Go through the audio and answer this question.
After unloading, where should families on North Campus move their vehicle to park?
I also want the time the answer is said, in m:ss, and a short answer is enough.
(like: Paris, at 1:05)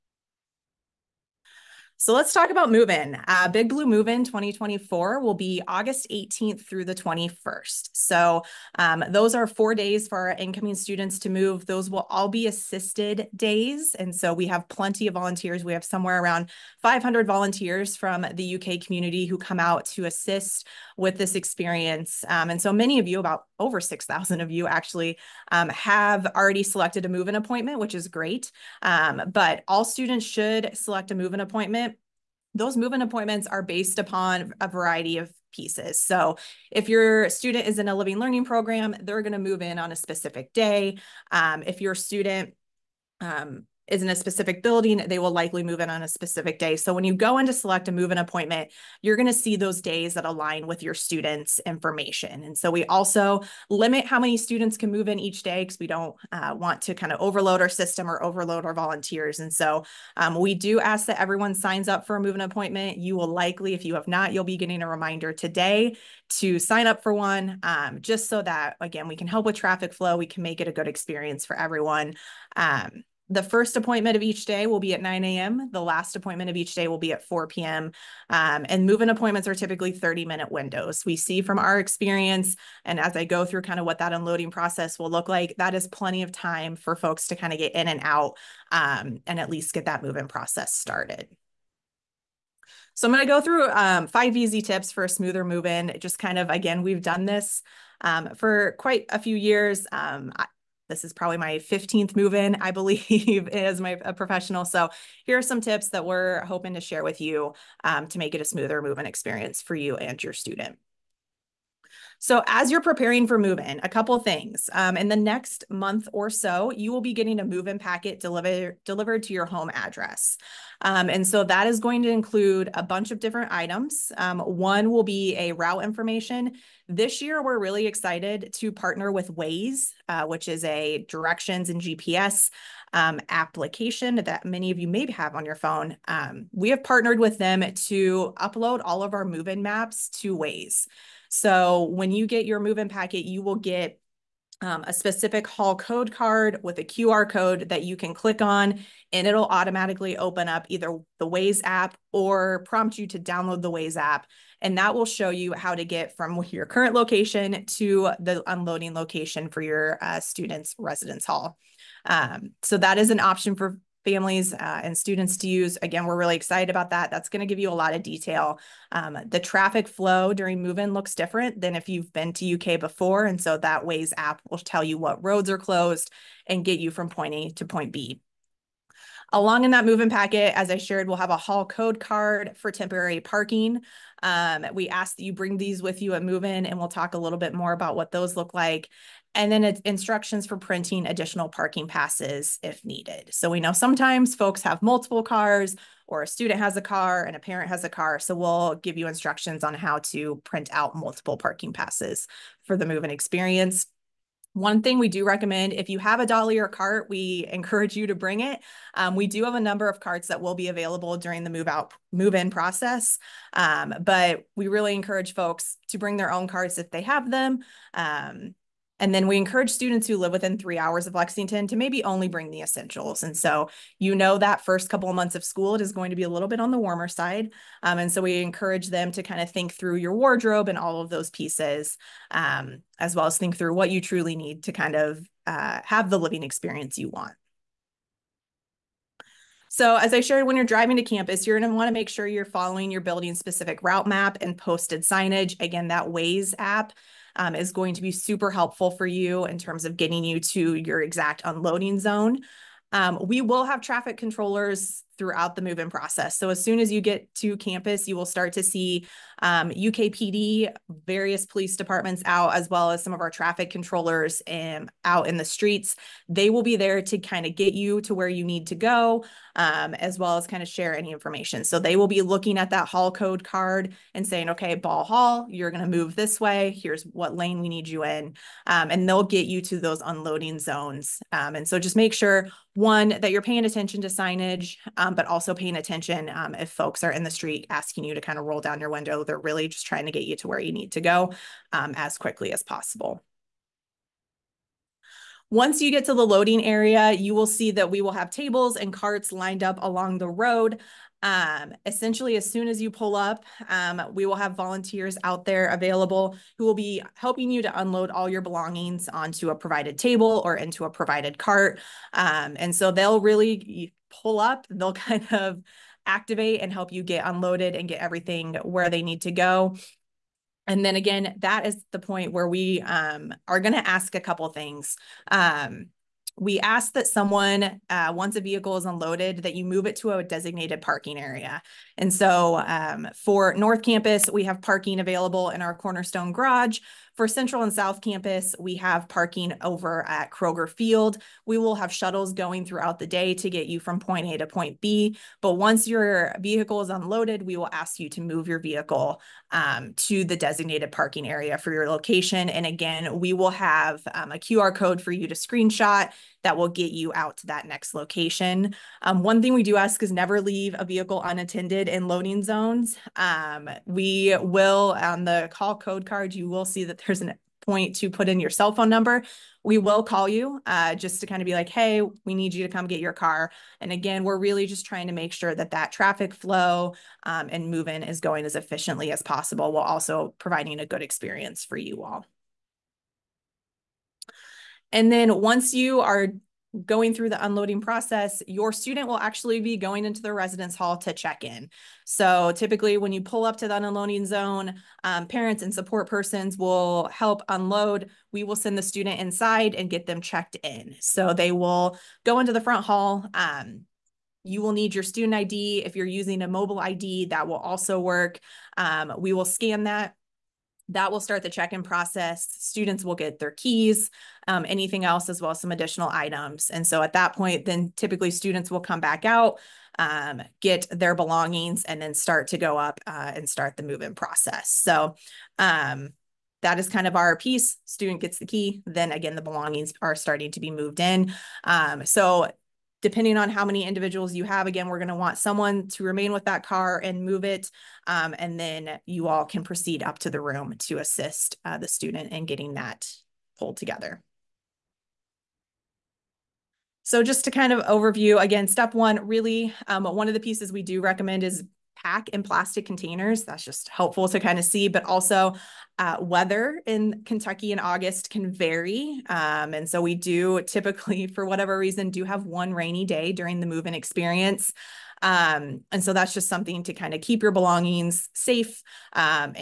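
Cornerstone Garage, at 5:35.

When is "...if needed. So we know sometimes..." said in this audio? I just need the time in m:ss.
3:12.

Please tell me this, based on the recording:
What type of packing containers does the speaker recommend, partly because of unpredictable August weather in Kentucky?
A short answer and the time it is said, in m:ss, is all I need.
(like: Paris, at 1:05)
plastic containers, at 7:32.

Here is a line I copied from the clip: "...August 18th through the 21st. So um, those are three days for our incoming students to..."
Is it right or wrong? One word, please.
wrong.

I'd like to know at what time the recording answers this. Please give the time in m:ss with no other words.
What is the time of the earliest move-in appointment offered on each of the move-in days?
1:15.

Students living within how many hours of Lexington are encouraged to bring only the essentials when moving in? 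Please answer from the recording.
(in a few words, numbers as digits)
3 hours.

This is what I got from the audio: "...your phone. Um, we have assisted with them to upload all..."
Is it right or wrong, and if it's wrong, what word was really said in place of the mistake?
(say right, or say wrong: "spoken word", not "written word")
wrong: "partnered", not "assisted".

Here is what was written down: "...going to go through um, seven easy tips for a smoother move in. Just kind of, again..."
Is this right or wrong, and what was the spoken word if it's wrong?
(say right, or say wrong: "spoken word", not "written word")
wrong: "five", not "seven".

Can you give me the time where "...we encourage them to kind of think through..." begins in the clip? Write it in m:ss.
3:48.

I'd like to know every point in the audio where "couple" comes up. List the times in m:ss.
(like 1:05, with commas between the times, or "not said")
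1:53, 3:44, 5:24.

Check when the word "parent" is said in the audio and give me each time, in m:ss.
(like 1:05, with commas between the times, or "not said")
3:17, 6:35.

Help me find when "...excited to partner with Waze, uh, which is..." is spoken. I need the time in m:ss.
2:07.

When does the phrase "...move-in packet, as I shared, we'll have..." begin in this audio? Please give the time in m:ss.
2:59.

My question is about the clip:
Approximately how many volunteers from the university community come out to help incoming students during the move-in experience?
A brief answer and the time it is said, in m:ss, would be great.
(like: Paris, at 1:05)
500, at 0:16.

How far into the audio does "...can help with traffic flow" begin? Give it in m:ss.
1:09.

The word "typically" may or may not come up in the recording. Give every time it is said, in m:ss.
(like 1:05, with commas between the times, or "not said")
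1:19, 6:32, 6:57, 7:40.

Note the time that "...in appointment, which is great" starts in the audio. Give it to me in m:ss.
0:27.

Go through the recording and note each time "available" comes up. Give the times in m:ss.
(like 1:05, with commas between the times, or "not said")
3:30, 5:05, 5:34.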